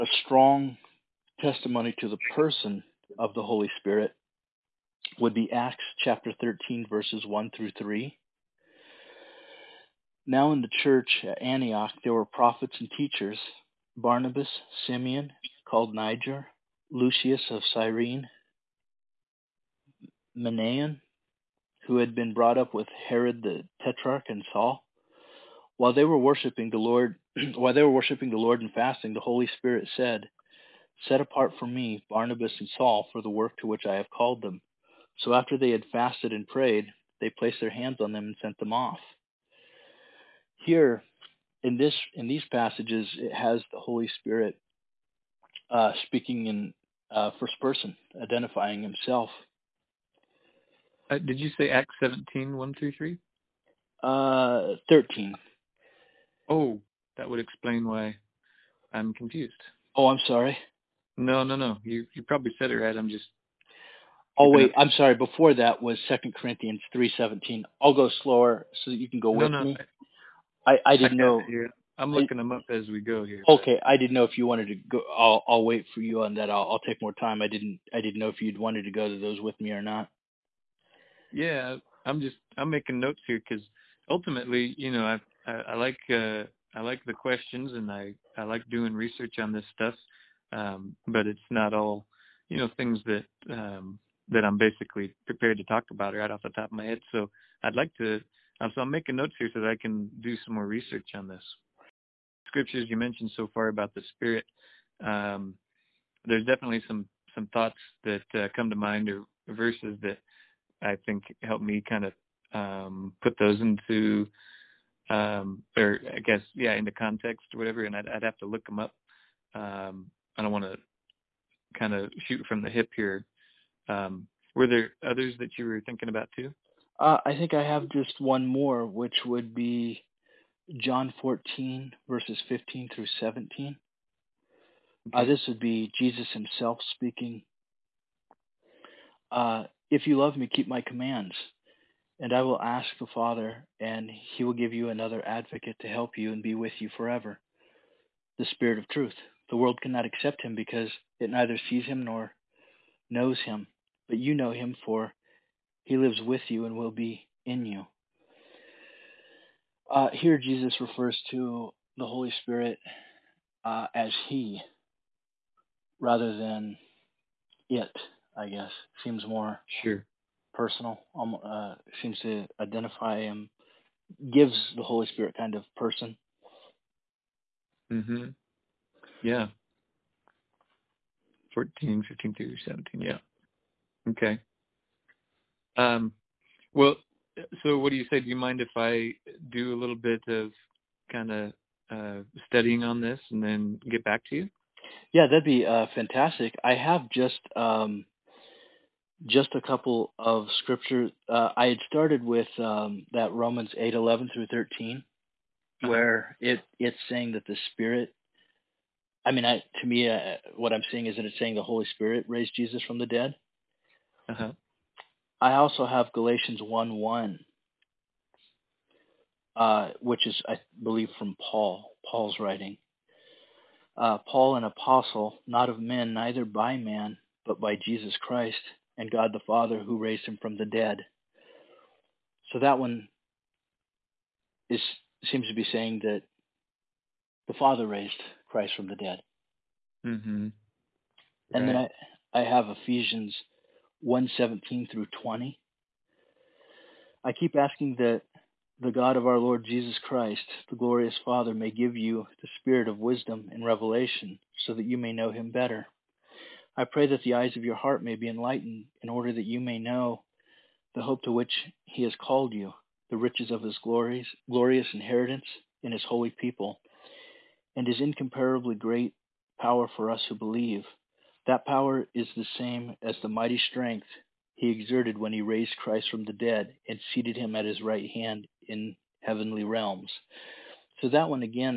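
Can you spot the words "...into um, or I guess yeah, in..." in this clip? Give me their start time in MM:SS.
01:53.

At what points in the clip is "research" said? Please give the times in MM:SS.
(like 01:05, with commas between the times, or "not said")
01:28, 01:40.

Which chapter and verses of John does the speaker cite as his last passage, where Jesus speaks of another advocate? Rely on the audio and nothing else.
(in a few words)
John 14:15-17.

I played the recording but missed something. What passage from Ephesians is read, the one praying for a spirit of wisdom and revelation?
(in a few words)
Ephesians 1:17-20.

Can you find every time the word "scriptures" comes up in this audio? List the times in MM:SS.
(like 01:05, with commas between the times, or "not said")
01:42, 03:20.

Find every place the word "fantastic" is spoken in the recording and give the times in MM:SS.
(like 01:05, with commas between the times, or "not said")
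03:15.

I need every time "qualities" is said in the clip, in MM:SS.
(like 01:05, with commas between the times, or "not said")
not said.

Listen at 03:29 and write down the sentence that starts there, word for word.
I mean, I, to me, uh, what I'm seeing is that it's saying the Holy Spirit raised Jesus from the dead.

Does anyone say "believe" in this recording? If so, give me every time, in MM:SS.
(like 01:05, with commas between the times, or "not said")
03:40, 04:30.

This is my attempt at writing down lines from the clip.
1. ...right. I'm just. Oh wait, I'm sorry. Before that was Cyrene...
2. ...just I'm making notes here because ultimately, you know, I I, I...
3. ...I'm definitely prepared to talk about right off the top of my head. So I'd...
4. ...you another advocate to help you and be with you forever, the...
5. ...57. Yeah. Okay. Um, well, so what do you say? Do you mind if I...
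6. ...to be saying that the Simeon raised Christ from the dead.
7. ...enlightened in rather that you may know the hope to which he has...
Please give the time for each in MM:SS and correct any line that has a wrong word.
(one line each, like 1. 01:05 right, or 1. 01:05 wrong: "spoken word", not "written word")
1. 01:02 wrong: "Second", not "Cyrene"
2. 01:22 right
3. 01:34 wrong: "basically", not "definitely"
4. 02:24 right
5. 03:02 wrong: "17", not "57"
6. 03:55 wrong: "Father", not "Simeon"
7. 04:18 wrong: "order", not "rather".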